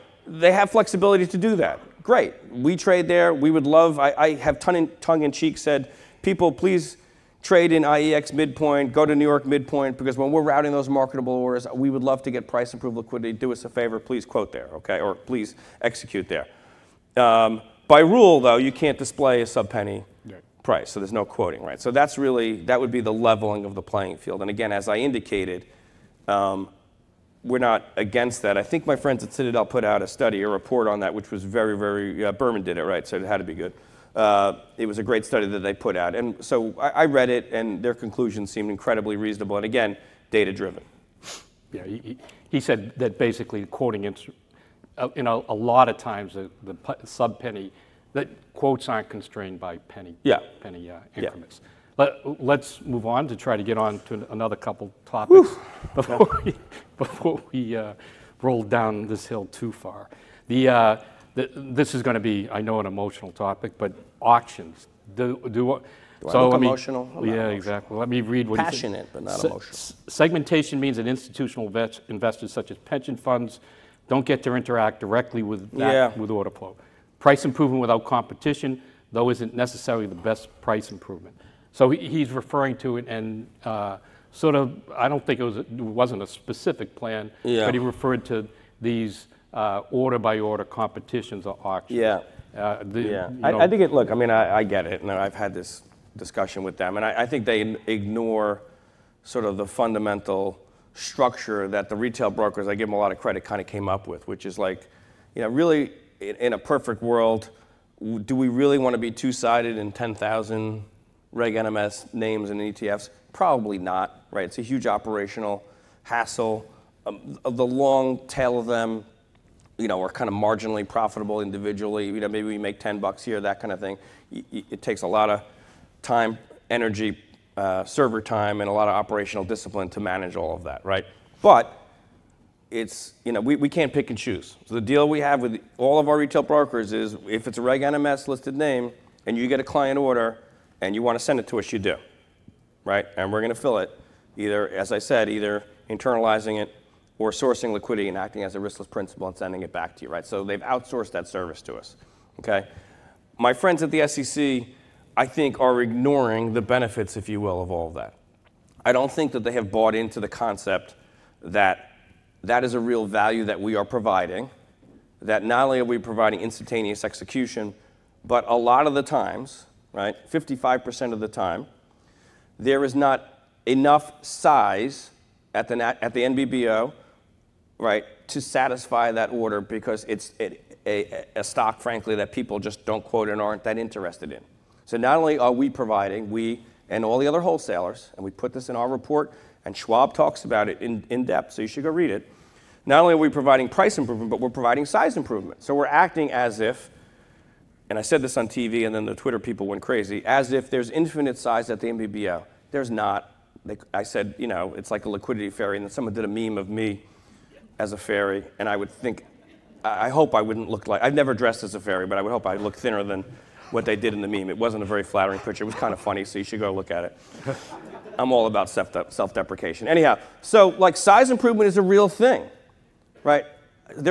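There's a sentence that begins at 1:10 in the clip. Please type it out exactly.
Segmentation means that institutional investors, such as pension funds, don't get to interact directly with that, yeah.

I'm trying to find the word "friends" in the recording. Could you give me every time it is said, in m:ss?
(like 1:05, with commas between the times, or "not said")
0:28, 2:33.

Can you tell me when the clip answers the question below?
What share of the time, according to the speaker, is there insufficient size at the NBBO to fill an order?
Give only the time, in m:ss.
2:50.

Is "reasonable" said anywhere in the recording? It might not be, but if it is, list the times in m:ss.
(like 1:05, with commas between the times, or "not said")
0:39.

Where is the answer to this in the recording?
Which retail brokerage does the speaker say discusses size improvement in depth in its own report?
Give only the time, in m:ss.
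3:09.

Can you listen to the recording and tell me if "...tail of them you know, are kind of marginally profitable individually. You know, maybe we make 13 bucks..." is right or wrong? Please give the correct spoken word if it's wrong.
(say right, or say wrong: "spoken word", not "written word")
wrong: "10", not "13".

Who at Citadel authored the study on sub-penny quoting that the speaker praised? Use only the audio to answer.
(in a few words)
Berman.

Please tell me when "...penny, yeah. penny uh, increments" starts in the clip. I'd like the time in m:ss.
0:49.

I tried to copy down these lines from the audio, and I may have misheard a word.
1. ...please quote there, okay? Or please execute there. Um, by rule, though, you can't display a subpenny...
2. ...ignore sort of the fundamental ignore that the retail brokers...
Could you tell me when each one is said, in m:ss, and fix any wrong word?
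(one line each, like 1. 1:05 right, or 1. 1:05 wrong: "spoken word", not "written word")
1. 0:14 right
2. 1:37 wrong: "structure", not "ignore".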